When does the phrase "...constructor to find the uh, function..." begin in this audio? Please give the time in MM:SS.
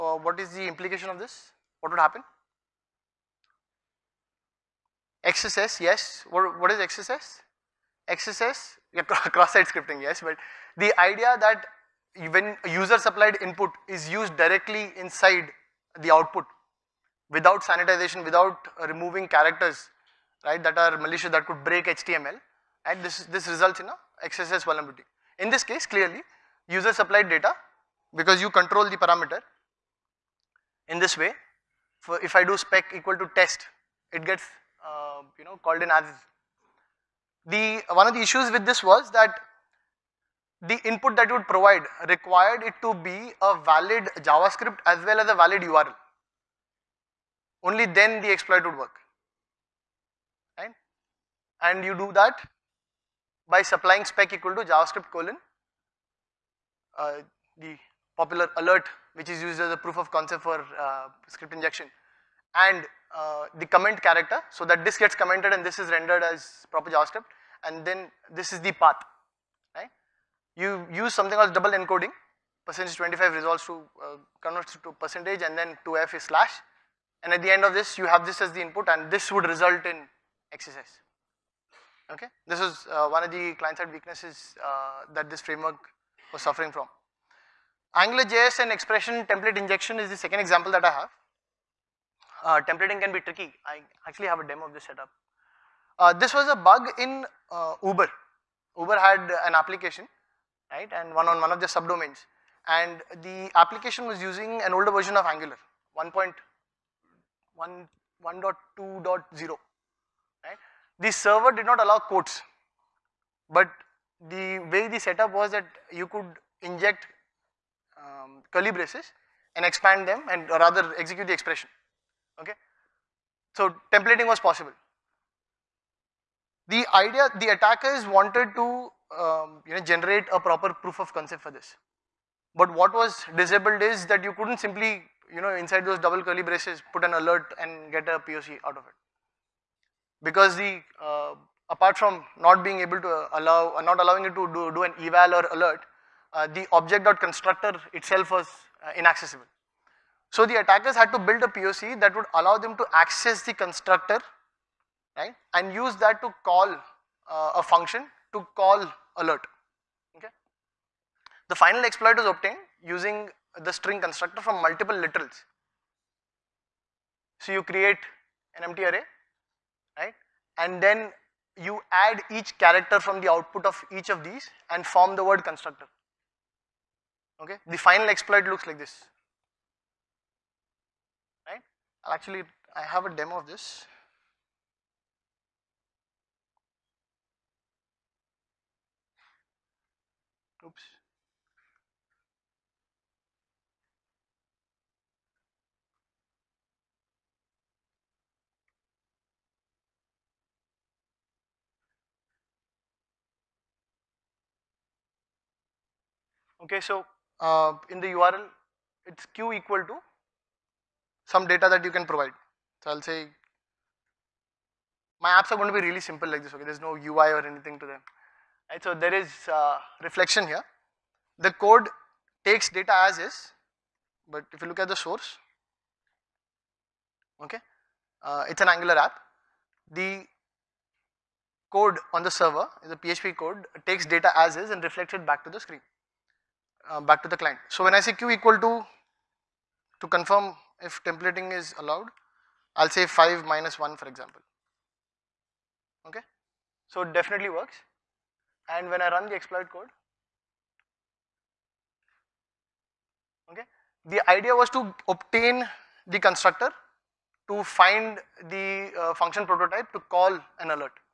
04:16.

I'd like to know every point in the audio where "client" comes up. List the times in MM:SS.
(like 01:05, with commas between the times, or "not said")
01:23, 03:57.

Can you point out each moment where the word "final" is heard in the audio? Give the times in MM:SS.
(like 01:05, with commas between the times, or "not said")
02:41, 02:57.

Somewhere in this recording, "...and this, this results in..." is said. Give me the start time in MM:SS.
00:22.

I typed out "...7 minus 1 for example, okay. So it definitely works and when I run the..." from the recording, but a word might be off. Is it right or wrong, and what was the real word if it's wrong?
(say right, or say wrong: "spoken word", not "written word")
wrong: "5", not "7".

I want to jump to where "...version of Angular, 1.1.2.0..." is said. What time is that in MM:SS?
01:44.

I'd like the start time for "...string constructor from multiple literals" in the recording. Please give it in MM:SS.
02:43.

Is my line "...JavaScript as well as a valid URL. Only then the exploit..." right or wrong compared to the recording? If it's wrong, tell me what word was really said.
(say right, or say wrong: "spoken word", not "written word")
right.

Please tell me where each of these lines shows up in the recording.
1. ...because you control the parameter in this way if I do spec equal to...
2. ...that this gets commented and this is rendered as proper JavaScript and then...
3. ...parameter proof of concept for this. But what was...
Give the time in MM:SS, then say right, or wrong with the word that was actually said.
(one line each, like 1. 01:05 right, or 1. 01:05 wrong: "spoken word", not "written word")
1. 00:28 right
2. 01:04 right
3. 02:10 wrong: "proper", not "parameter".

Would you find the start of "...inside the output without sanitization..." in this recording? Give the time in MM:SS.
00:14.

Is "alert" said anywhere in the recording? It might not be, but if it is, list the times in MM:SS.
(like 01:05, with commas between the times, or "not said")
00:58, 02:17, 02:25, 02:39.